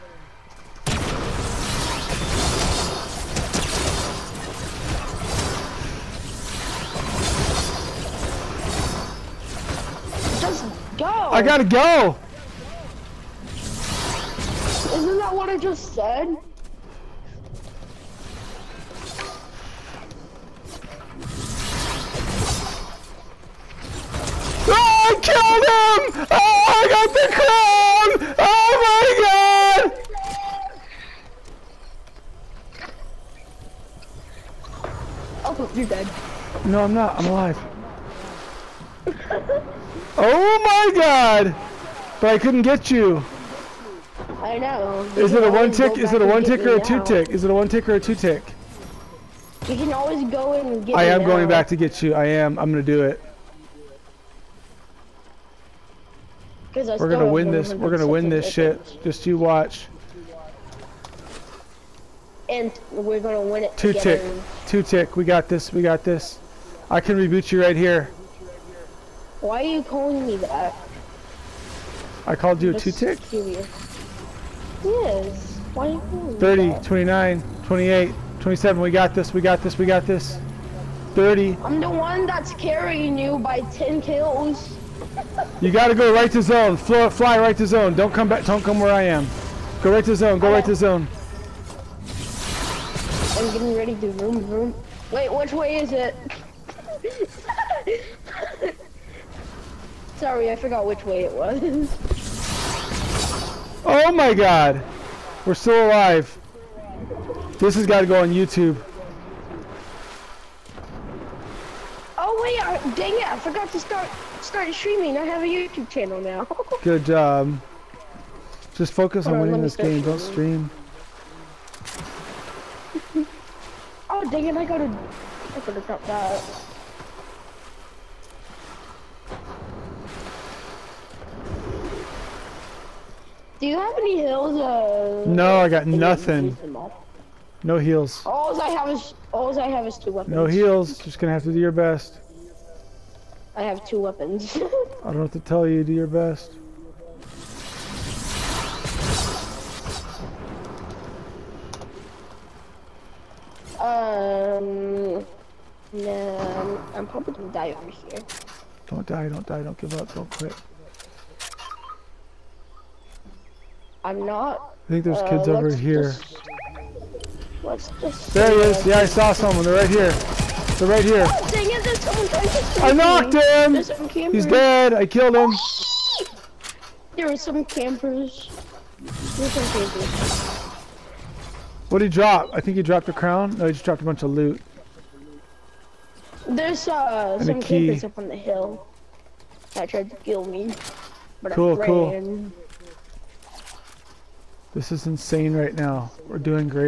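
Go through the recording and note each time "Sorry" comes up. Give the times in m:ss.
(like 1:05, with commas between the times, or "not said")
1:40.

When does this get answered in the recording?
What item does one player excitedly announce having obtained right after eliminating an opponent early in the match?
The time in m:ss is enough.
0:27.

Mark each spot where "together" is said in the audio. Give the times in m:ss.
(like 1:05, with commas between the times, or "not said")
1:03.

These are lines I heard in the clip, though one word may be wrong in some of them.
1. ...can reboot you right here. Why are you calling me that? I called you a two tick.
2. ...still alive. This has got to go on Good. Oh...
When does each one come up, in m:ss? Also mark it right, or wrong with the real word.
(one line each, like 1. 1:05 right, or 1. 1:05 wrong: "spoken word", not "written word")
1. 1:06 right
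2. 1:45 wrong: "YouTube", not "Good".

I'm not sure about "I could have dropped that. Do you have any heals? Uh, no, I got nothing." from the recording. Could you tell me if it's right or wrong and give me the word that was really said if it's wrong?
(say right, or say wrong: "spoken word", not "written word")
right.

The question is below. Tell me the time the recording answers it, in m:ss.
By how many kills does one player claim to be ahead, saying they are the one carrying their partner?
1:23.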